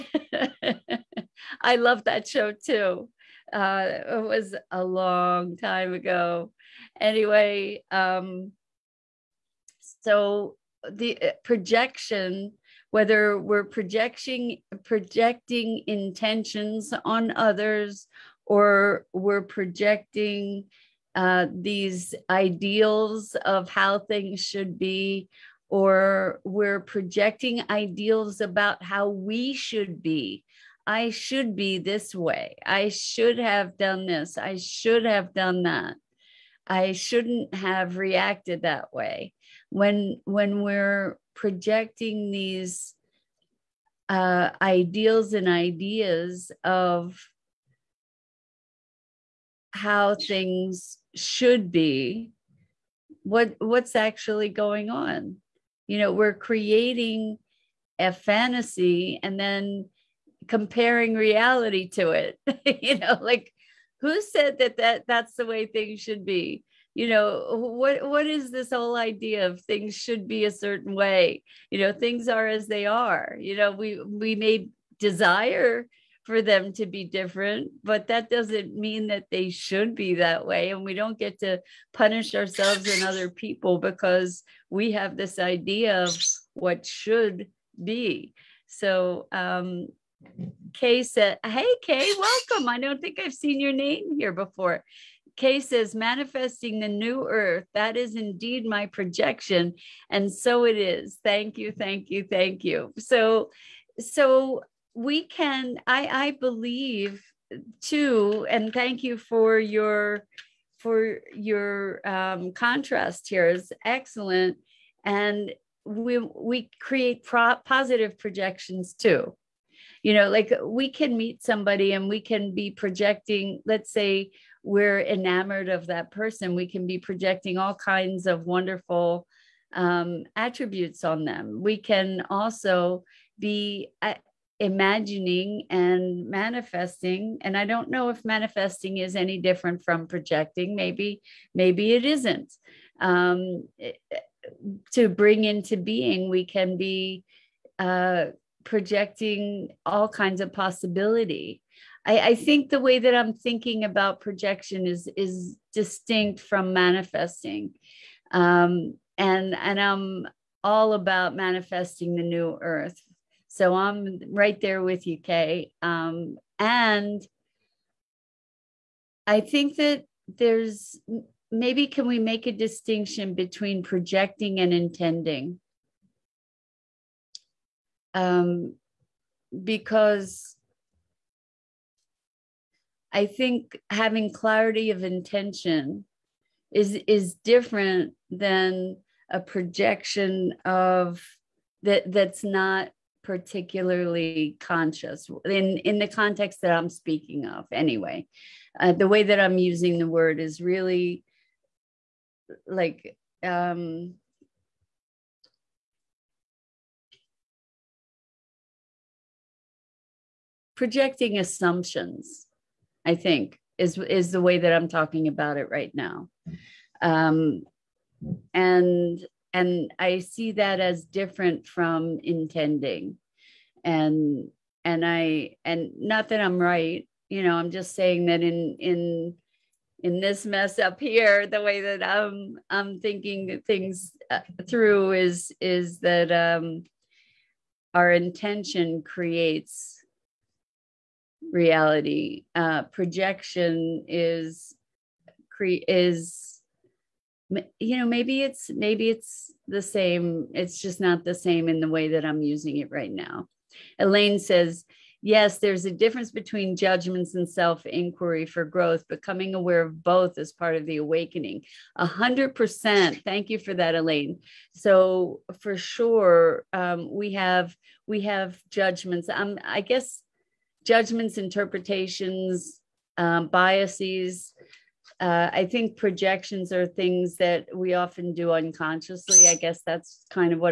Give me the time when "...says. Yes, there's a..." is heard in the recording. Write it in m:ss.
4:14.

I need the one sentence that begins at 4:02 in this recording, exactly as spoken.
Uh, projection is cre- is you know maybe it's maybe it's the same.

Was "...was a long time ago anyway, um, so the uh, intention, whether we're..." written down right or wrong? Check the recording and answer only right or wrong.
wrong.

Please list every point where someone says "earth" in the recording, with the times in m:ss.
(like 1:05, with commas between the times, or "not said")
1:37, 2:42.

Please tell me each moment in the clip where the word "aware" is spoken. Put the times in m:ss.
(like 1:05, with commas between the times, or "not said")
4:19.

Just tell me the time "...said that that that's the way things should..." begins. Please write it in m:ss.
1:04.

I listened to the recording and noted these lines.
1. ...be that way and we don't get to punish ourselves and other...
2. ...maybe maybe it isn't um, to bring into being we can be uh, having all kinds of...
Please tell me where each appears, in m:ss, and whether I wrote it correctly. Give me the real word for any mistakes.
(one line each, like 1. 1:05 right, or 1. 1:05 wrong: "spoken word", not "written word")
1. 1:19 right
2. 2:20 wrong: "projecting", not "having".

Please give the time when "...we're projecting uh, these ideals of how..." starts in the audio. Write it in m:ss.
0:19.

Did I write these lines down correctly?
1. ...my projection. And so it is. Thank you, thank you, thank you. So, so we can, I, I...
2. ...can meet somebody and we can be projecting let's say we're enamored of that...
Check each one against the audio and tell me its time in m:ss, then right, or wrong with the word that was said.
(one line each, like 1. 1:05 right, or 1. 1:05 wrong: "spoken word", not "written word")
1. 1:38 right
2. 2:00 right.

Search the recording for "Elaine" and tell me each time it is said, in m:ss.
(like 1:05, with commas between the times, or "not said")
4:13, 4:23.